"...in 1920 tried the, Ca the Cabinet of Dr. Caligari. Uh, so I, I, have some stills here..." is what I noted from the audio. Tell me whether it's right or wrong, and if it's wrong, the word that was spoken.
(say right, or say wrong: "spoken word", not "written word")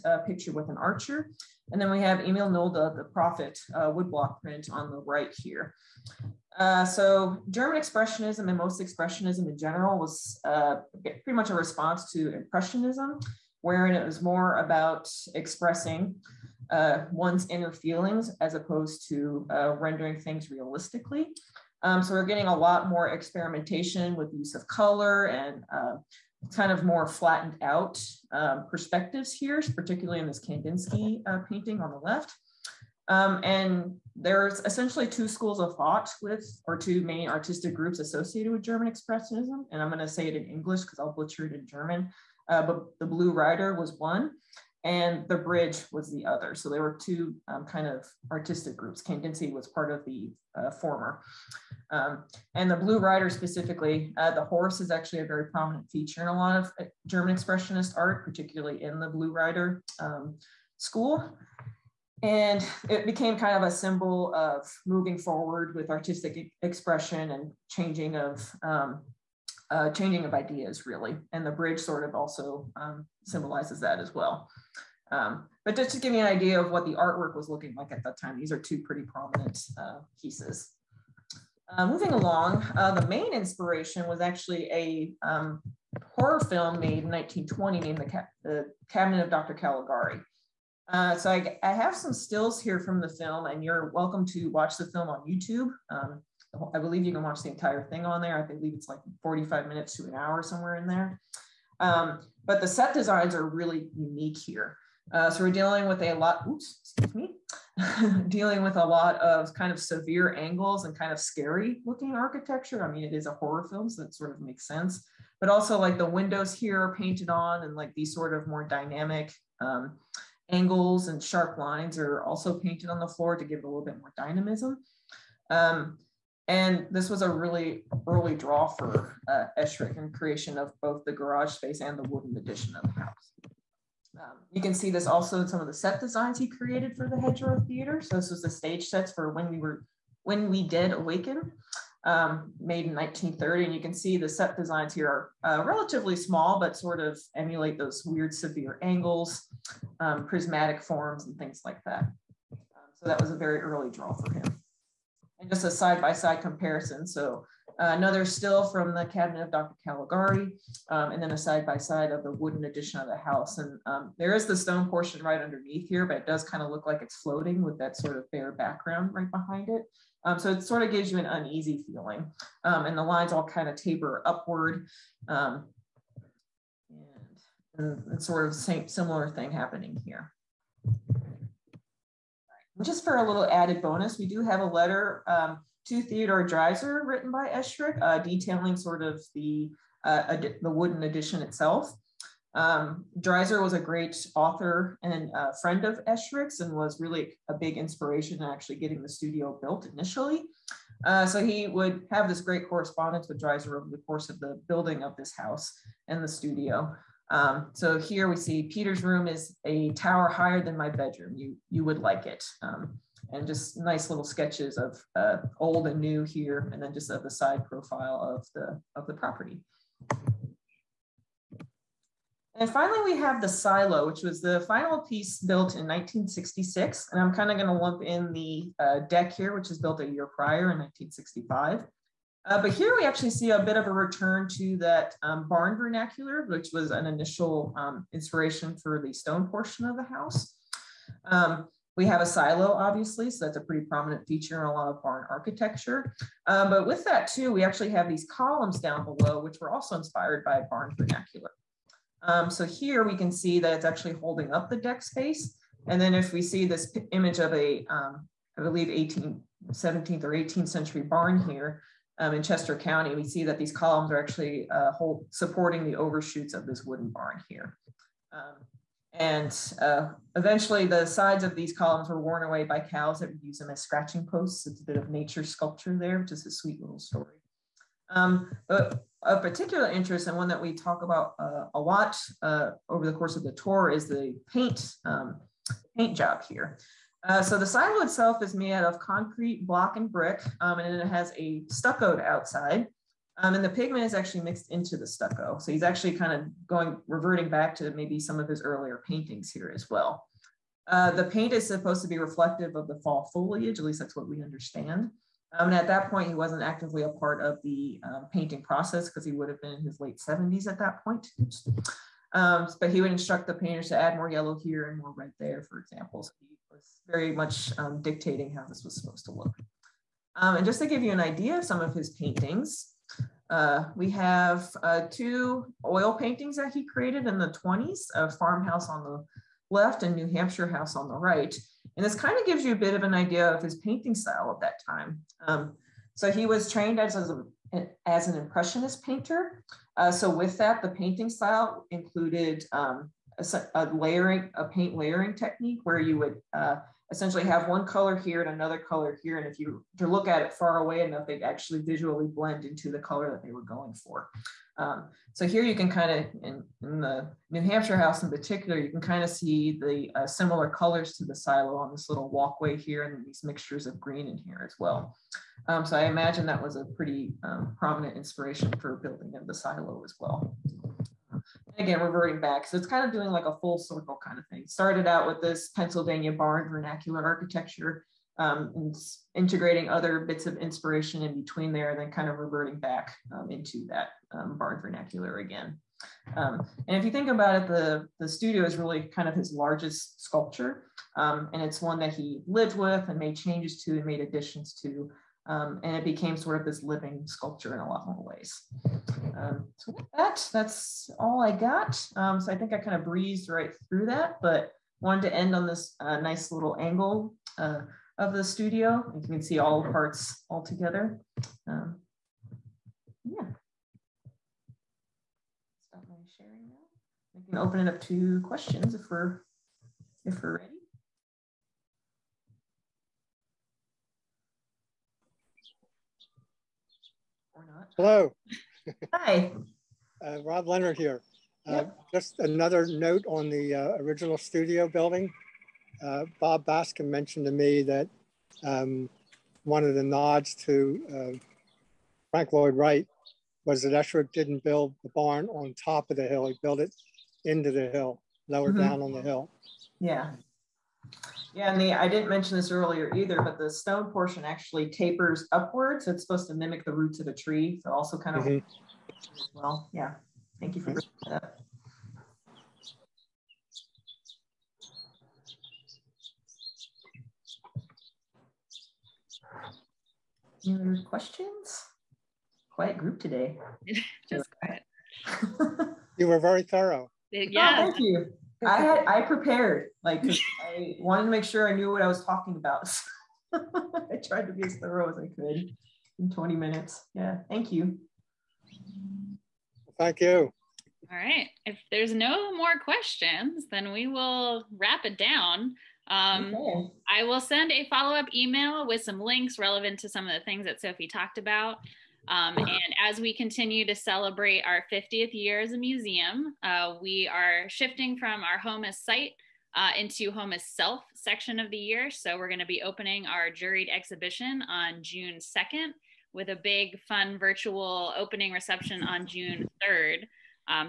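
wrong: "named", not "tried".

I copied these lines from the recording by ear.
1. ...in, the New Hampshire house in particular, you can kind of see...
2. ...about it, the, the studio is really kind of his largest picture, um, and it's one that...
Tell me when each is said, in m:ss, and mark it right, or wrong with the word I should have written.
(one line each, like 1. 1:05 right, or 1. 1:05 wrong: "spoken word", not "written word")
1. 5:56 right
2. 6:27 wrong: "sculpture", not "picture".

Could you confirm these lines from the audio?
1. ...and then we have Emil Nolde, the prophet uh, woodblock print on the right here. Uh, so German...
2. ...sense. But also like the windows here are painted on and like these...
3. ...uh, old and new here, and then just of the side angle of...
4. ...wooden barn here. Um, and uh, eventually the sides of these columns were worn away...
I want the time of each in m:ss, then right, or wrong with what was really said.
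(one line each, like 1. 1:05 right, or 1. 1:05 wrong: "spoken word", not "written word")
1. 0:01 right
2. 1:54 right
3. 3:35 wrong: "profile", not "angle"
4. 4:26 right.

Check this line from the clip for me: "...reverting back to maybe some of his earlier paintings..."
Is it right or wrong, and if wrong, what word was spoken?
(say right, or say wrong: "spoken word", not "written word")
right.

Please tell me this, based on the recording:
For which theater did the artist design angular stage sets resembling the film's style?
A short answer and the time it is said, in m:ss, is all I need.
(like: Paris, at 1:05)
Hedgerow Theater, at 2:17.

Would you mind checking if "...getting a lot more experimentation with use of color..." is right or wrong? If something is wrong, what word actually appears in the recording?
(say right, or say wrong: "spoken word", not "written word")
right.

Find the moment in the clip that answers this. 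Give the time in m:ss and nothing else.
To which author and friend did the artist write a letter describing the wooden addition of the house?
3:06.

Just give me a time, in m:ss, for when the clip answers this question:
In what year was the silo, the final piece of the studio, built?
3:45.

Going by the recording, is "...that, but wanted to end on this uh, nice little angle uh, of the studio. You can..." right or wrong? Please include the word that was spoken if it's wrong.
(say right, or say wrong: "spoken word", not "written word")
right.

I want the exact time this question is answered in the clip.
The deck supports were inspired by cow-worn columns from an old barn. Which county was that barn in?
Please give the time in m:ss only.
4:22.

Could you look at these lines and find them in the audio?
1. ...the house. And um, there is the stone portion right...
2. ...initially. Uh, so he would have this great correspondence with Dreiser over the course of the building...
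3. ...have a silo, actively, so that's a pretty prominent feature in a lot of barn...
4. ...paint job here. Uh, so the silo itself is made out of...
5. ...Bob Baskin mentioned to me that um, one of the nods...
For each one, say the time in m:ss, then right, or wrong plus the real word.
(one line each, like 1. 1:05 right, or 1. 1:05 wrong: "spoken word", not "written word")
1. 2:43 right
2. 3:19 right
3. 4:02 wrong: "obviously", not "actively"
4. 4:45 right
5. 7:16 right.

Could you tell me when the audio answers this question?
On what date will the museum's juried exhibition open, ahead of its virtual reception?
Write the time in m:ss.
8:35.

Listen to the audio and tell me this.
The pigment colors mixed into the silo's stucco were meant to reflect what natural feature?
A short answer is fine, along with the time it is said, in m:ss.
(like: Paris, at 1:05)
fall foliage, at 5:03.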